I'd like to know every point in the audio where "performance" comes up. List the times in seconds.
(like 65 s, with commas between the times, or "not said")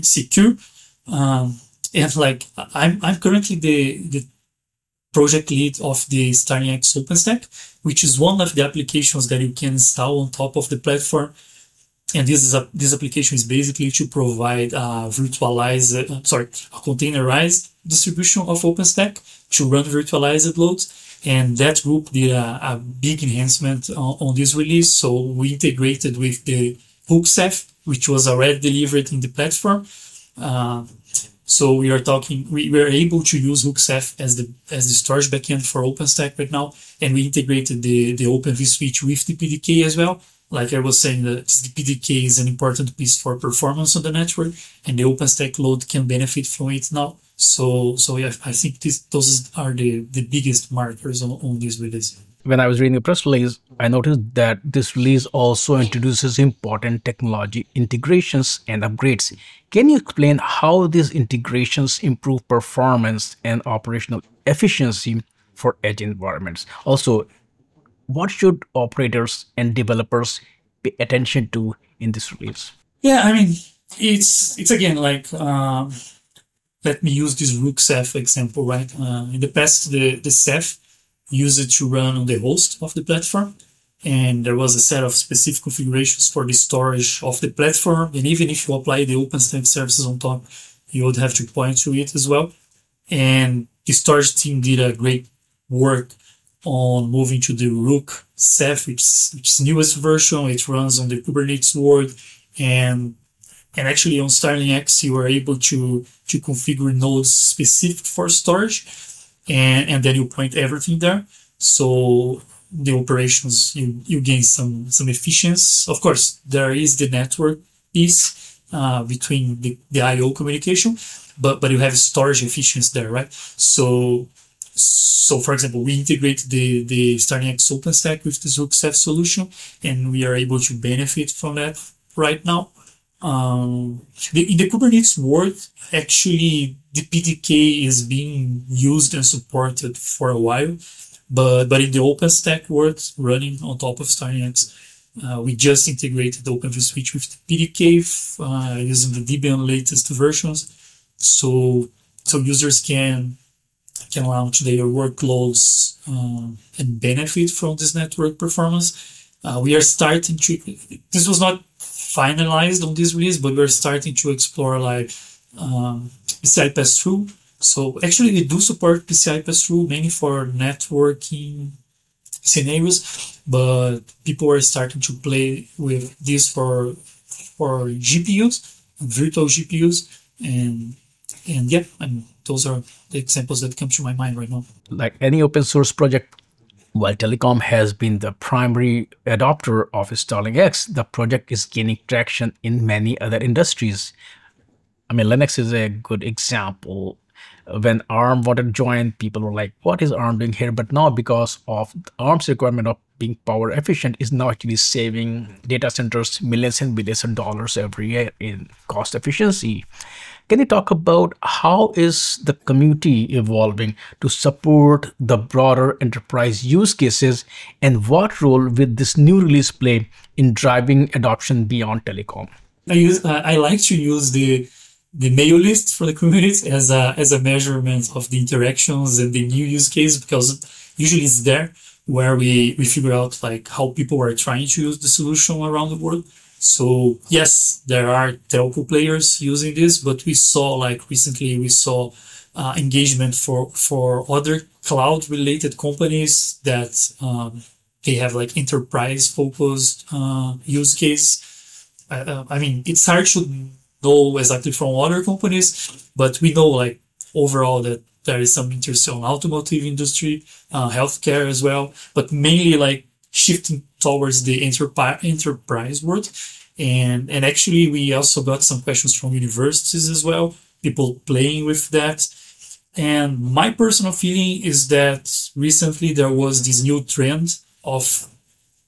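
43 s, 62 s, 158 s.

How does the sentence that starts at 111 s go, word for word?
So the operations, you, you gain some, some efficiency.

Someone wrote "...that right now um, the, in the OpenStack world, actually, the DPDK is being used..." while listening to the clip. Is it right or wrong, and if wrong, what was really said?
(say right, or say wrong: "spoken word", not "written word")
wrong: "Kubernetes", not "OpenStack".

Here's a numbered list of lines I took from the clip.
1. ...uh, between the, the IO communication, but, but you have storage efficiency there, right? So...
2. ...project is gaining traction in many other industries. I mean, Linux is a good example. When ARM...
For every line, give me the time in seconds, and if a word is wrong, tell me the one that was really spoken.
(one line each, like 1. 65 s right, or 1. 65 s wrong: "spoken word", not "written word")
1. 118 s right
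2. 191 s right.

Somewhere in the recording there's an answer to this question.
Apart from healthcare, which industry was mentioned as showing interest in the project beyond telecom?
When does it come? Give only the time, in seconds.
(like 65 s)
259 s.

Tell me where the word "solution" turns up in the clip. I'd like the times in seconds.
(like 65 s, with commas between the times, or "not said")
128 s, 235 s.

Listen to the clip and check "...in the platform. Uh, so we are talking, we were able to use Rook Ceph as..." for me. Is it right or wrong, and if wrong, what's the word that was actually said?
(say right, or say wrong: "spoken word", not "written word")
right.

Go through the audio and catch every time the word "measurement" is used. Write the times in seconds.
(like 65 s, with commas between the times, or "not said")
227 s.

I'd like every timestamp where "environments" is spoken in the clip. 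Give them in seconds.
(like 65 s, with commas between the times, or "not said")
66 s.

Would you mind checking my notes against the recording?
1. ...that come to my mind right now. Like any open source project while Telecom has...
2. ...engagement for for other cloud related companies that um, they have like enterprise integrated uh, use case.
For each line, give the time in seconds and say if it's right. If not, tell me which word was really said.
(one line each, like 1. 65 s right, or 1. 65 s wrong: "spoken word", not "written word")
1. 183 s right
2. 242 s wrong: "focused", not "integrated".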